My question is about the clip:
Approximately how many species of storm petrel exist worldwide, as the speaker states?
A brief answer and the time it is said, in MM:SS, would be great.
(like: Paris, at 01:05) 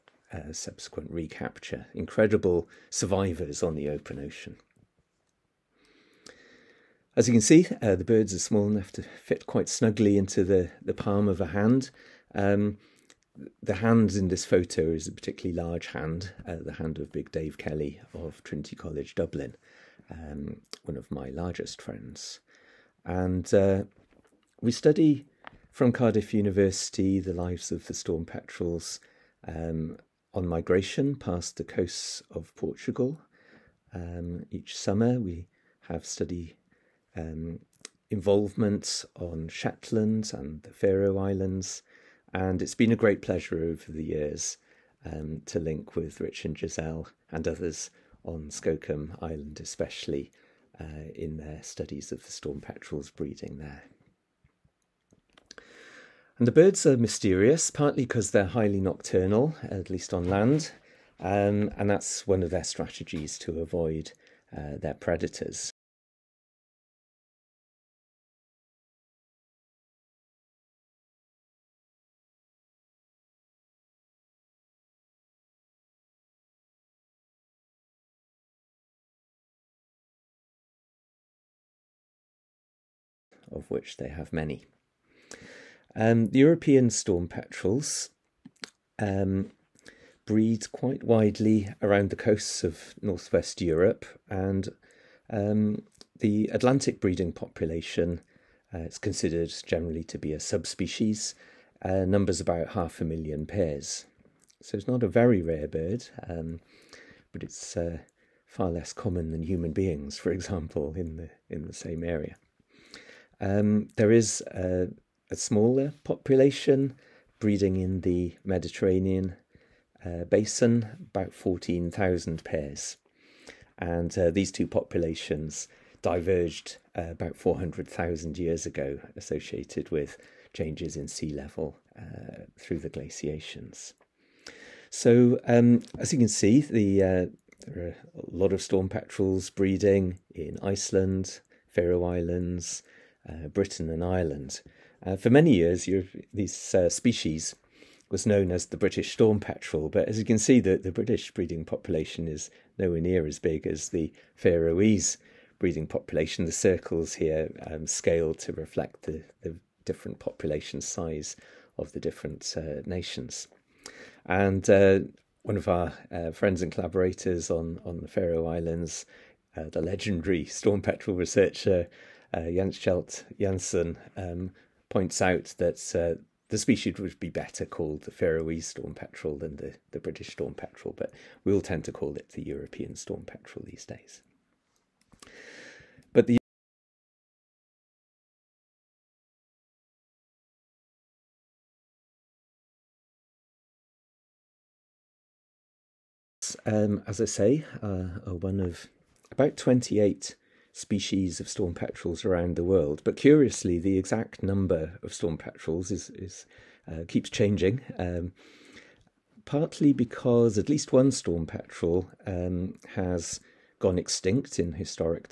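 28, at 03:19.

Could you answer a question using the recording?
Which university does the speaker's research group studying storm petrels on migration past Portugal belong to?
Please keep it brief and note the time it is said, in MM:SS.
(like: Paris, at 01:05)
Cardiff University, at 00:25.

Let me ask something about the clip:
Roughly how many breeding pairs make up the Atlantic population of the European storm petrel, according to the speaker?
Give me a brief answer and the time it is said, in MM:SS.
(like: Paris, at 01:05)
half a million, at 01:42.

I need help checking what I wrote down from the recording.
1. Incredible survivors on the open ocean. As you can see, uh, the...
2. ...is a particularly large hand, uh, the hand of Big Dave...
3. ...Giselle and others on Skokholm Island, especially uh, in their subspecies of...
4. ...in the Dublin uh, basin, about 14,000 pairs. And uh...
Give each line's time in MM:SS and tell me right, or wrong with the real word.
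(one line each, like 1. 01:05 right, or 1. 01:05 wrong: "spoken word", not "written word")
1. 00:01 right
2. 00:14 right
3. 00:46 wrong: "studies", not "subspecies"
4. 01:57 wrong: "Mediterranean", not "Dublin".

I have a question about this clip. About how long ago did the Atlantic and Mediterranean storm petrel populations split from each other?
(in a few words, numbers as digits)
400,000 years ago.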